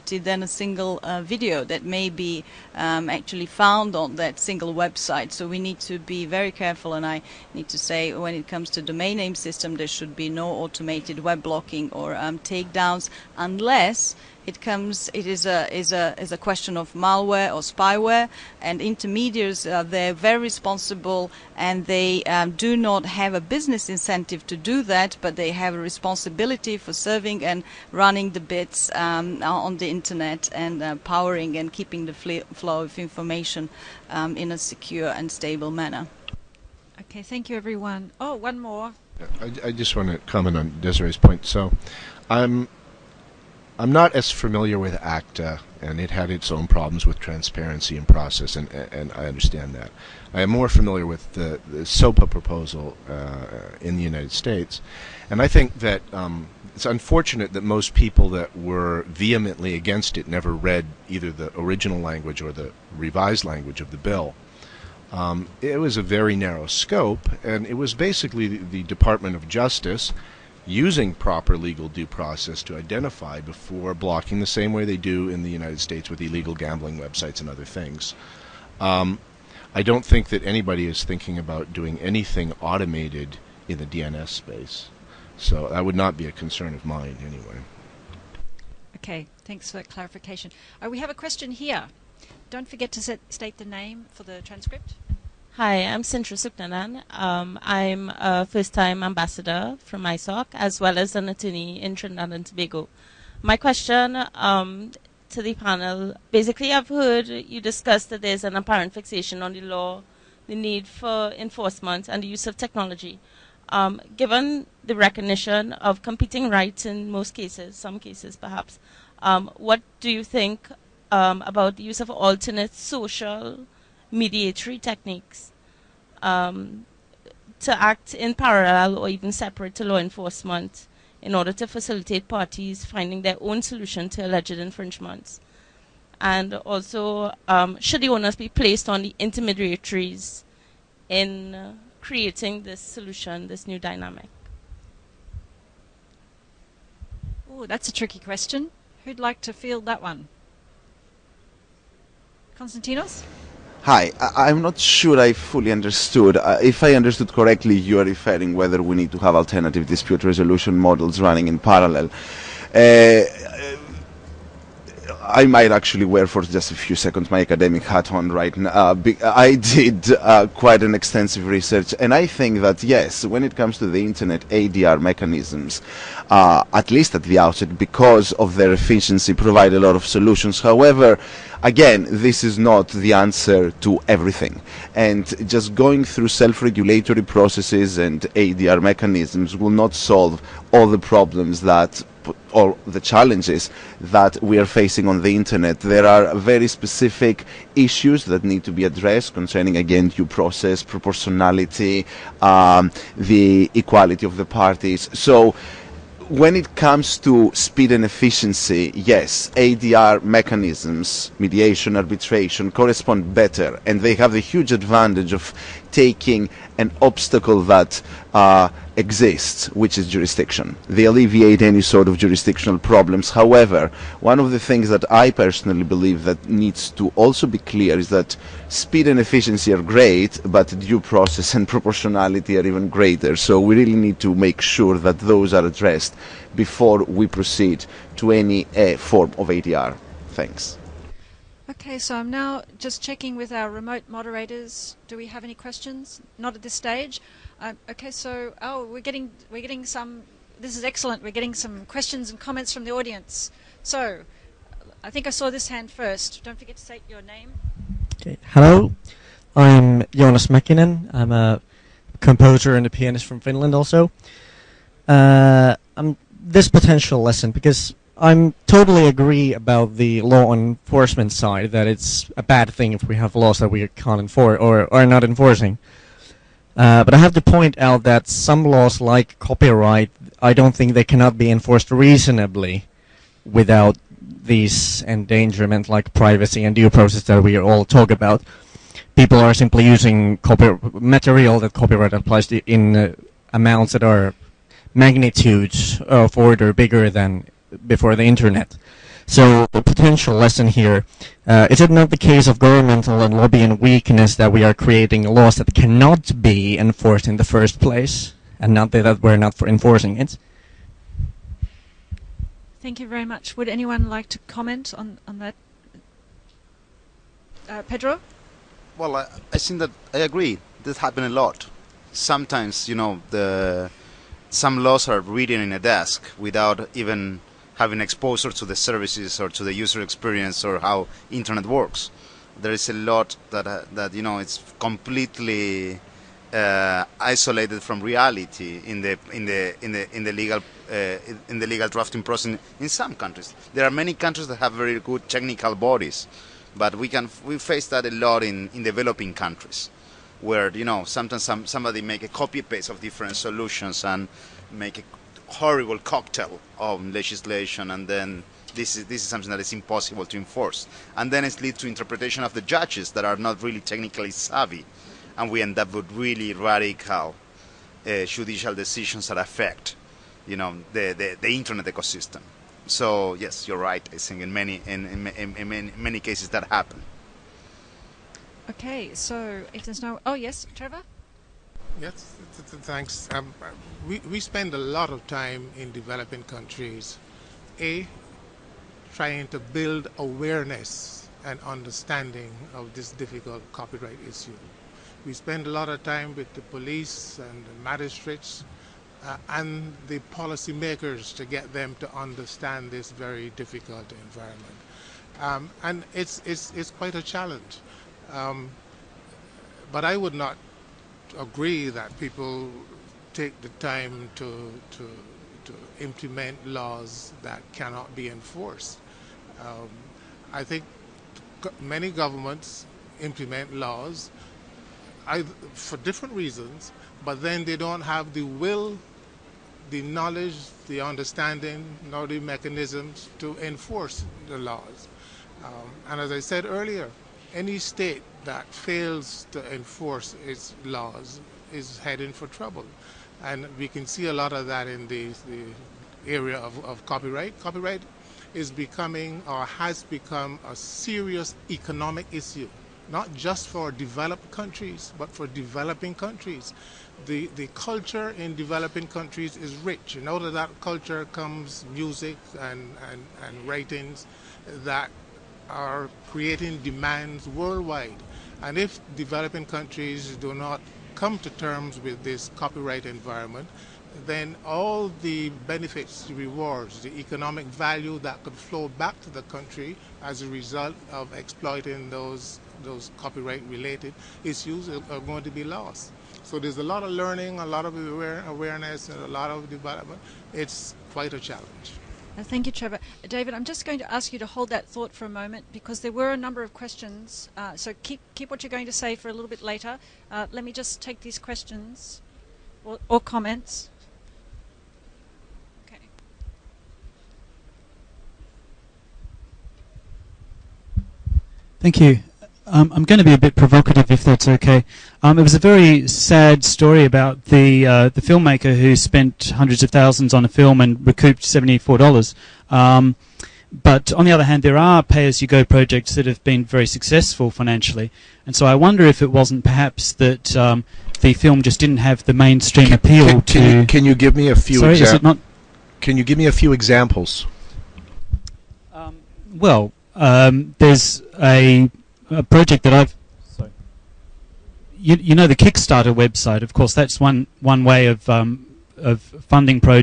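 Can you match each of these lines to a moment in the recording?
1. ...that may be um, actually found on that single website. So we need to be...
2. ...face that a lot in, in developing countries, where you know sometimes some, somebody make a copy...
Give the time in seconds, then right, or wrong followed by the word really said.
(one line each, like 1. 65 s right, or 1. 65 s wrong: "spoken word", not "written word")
1. 1 s right
2. 347 s right.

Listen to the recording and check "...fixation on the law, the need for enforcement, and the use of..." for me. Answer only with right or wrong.
right.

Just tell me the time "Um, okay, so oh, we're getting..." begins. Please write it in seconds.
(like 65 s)
247 s.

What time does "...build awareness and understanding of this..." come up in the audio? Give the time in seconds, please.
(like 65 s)
389 s.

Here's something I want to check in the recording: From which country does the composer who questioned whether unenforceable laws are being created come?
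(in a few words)
Finland.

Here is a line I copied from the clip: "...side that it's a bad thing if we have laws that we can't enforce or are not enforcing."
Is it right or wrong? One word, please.
right.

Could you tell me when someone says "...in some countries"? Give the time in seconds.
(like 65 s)
342 s.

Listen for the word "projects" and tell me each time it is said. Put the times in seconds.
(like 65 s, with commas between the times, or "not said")
525 s, 542 s.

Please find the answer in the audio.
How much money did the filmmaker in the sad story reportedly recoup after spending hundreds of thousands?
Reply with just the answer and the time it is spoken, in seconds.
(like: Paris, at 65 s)
$74, at 521 s.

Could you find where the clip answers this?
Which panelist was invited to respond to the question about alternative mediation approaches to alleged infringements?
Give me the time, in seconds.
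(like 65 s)
152 s.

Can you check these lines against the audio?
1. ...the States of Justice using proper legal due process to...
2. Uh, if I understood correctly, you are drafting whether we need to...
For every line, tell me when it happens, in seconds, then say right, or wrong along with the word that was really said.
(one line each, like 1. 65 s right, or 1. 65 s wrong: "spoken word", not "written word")
1. 68 s wrong: "Department", not "States"
2. 156 s wrong: "referring", not "drafting".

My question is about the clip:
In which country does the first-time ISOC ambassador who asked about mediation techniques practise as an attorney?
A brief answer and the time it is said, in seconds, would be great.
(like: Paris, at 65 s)
Trinidad and Tobago, at 101 s.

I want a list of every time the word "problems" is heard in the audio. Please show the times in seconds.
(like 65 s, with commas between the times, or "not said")
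46 s, 190 s, 222 s.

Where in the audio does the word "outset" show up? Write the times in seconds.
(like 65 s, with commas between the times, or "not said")
177 s.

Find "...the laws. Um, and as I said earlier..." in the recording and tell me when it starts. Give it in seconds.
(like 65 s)
434 s.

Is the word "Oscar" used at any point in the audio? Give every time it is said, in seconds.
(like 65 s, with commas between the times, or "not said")
not said.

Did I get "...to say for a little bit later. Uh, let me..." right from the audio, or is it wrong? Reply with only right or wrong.
right.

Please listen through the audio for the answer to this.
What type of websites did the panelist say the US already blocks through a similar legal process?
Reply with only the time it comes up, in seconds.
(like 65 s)
76 s.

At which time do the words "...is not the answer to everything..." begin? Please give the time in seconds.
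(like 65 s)
182 s.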